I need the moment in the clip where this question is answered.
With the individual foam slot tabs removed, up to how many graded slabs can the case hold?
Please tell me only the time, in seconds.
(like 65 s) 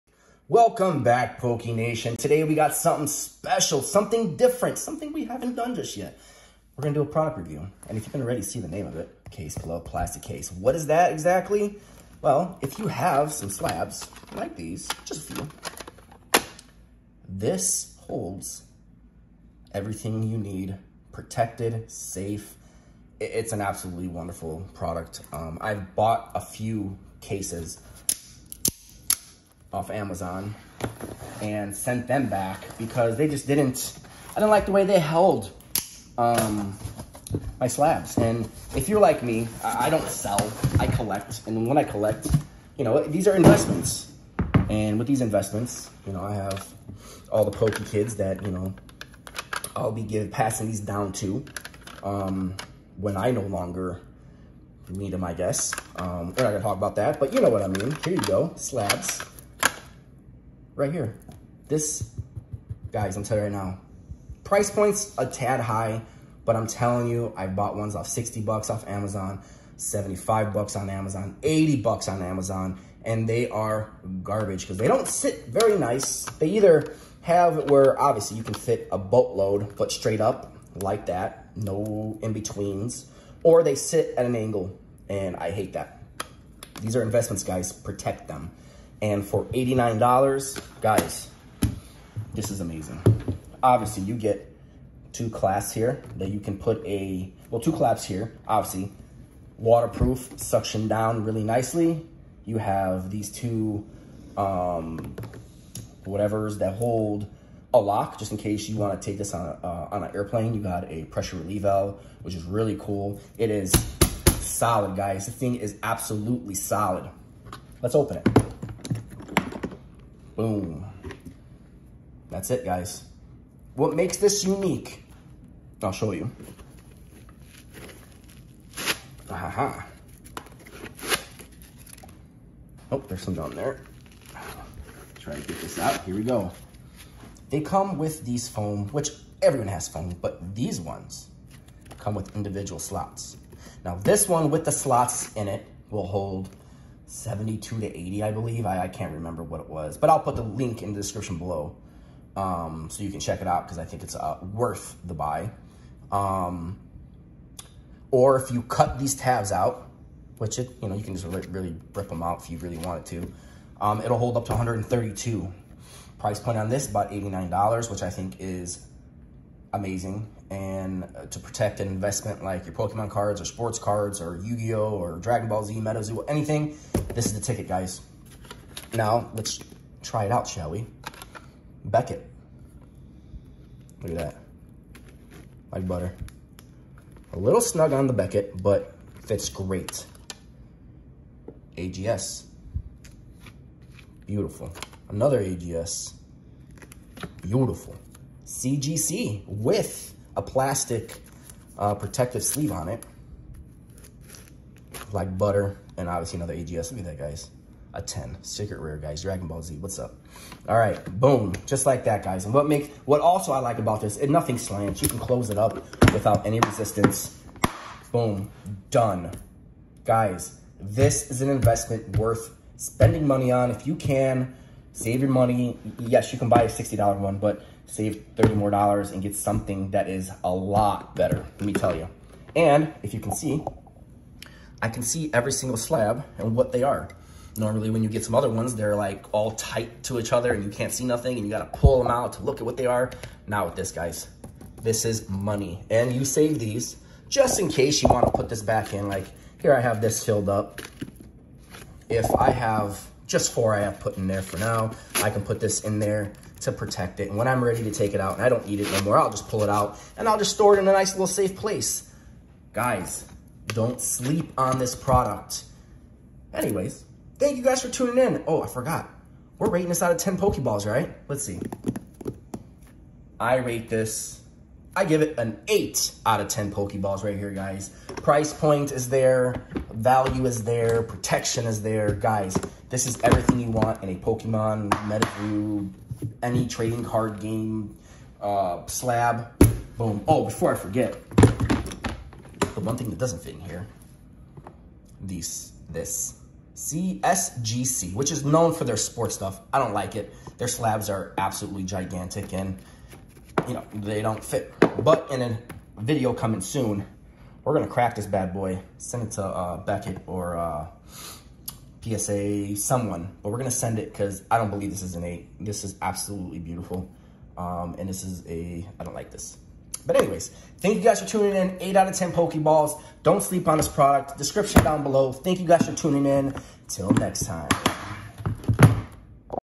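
164 s.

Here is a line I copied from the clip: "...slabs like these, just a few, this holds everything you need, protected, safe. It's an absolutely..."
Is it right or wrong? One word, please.
right.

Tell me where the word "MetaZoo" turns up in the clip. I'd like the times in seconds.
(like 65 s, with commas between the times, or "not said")
175 s, 284 s.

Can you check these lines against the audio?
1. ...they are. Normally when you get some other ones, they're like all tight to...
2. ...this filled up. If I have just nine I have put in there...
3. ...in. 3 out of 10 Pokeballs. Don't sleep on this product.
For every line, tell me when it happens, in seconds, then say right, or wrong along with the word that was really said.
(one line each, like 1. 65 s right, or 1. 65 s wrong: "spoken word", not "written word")
1. 236 s right
2. 250 s wrong: "four", not "nine"
3. 321 s wrong: "8", not "3".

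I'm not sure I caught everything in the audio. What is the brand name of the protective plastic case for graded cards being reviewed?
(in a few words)
Case Club.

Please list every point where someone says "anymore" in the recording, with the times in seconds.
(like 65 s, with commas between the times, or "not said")
258 s.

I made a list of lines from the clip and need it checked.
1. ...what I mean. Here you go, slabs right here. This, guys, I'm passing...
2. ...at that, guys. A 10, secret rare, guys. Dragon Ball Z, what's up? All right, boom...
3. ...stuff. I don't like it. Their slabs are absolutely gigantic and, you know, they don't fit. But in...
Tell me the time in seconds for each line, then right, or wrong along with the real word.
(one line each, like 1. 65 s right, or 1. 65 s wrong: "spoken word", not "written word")
1. 57 s wrong: "telling", not "passing"
2. 206 s right
3. 299 s right.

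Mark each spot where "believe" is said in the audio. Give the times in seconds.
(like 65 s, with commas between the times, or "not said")
148 s, 314 s.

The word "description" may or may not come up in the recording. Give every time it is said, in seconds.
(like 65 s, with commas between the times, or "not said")
151 s, 324 s.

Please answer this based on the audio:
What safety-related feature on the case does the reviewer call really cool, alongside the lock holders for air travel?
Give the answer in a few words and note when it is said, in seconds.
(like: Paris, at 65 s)
Pressure relief valve, at 111 s.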